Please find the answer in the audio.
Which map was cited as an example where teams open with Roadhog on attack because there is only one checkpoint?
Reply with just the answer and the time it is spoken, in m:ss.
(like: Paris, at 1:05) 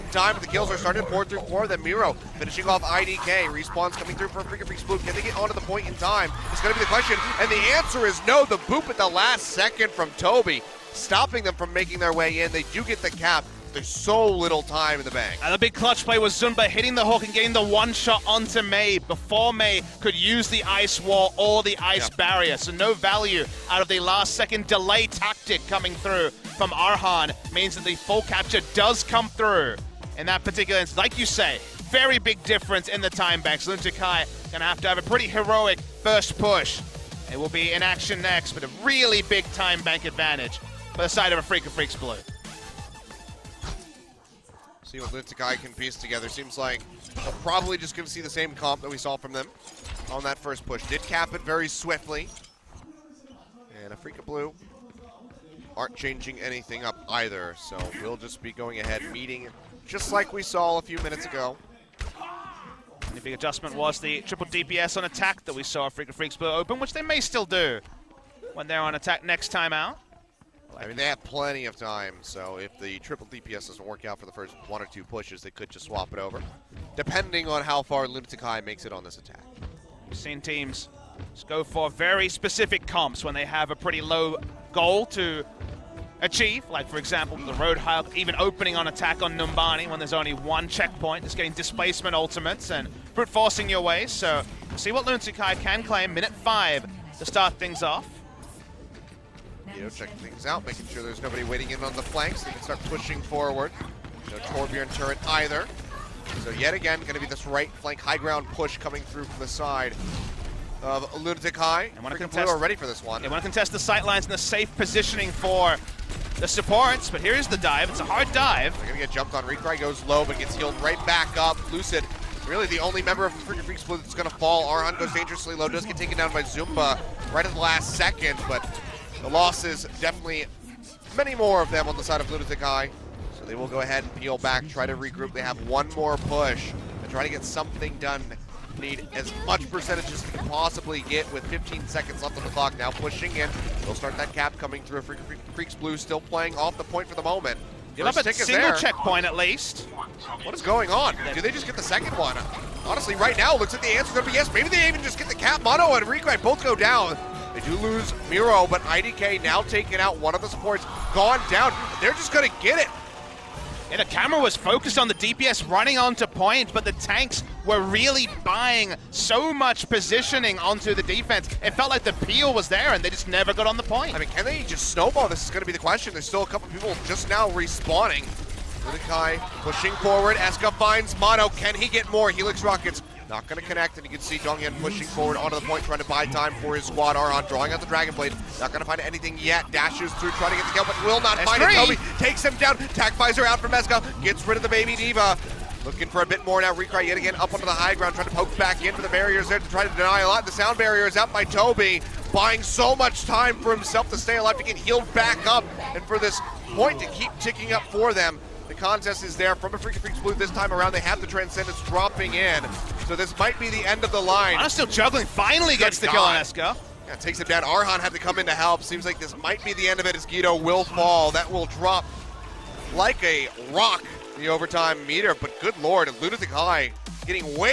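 Numbani, at 1:29.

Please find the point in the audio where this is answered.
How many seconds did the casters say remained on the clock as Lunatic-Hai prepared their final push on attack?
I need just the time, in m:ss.
2:21.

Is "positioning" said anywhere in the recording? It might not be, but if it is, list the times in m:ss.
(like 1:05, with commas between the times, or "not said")
1:54, 2:49.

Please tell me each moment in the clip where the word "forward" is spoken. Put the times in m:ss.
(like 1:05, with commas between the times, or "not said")
1:43, 2:59, 3:05.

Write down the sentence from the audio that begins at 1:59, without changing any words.
Recry goes low, but gets healed right back up.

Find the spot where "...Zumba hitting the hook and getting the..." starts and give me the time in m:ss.
0:16.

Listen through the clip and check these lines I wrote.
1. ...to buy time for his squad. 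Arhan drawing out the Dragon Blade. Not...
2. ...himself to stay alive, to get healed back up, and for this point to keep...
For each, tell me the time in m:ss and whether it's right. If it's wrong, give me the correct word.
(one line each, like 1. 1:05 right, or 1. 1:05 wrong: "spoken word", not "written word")
1. 3:05 right
2. 3:23 right.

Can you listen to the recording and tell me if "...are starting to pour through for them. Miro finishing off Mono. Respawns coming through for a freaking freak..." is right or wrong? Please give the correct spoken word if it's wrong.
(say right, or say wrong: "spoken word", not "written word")
wrong: "IDK", not "Mono".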